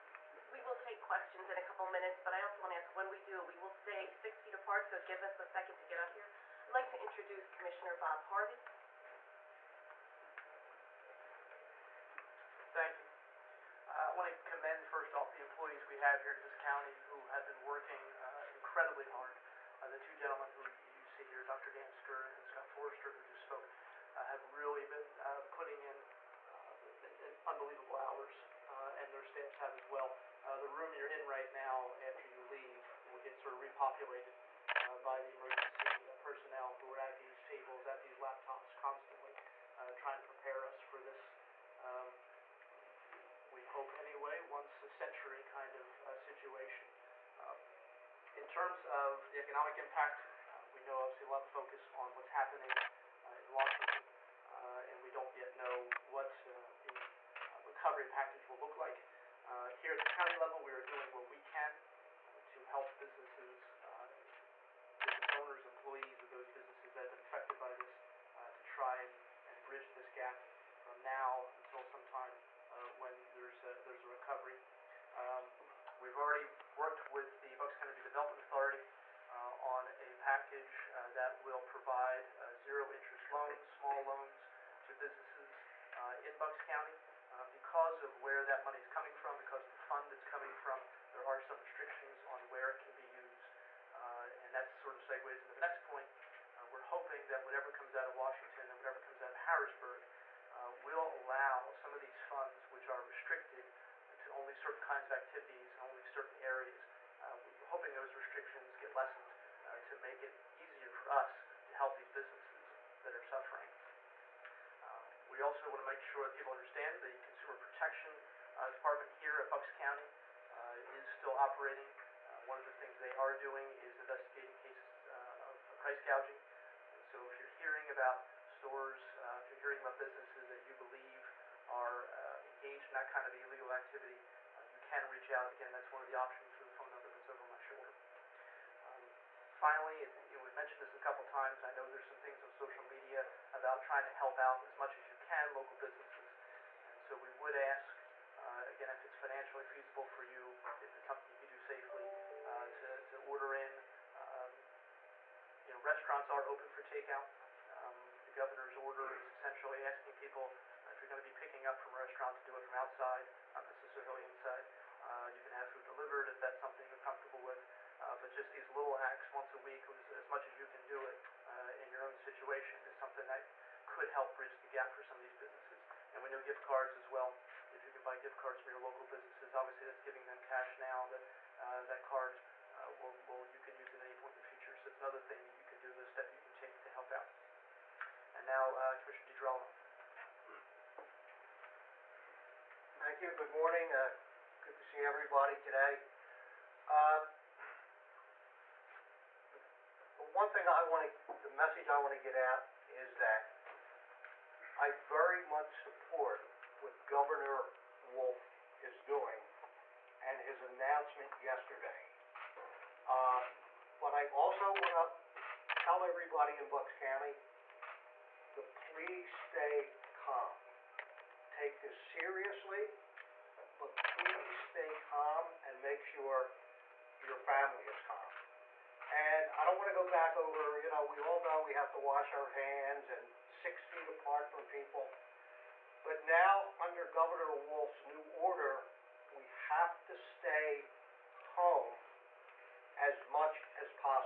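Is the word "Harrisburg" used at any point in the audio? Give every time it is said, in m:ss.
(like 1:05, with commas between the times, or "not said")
1:39.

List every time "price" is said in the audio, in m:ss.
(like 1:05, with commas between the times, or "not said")
2:05.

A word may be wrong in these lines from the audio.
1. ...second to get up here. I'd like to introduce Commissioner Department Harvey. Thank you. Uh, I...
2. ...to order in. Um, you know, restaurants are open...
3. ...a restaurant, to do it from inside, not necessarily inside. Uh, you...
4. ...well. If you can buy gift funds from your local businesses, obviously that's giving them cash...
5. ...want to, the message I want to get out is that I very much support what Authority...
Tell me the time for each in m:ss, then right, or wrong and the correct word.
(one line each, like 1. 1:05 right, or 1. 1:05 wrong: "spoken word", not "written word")
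1. 0:05 wrong: "Bob", not "Department"
2. 2:33 right
3. 2:41 wrong: "outside", not "inside"
4. 2:57 wrong: "cards", not "funds"
5. 3:20 wrong: "Governor", not "Authority".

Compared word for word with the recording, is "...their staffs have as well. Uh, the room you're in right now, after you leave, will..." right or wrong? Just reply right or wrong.
right.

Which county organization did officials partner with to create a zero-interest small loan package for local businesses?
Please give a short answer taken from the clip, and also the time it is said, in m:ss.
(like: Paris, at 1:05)
Bucks County Development Authority, at 1:17.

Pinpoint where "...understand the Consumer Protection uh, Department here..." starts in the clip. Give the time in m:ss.
1:56.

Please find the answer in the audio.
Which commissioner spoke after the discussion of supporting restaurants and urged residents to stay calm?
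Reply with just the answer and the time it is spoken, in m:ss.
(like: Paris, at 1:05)
Commissioner DiGirolamo, at 3:09.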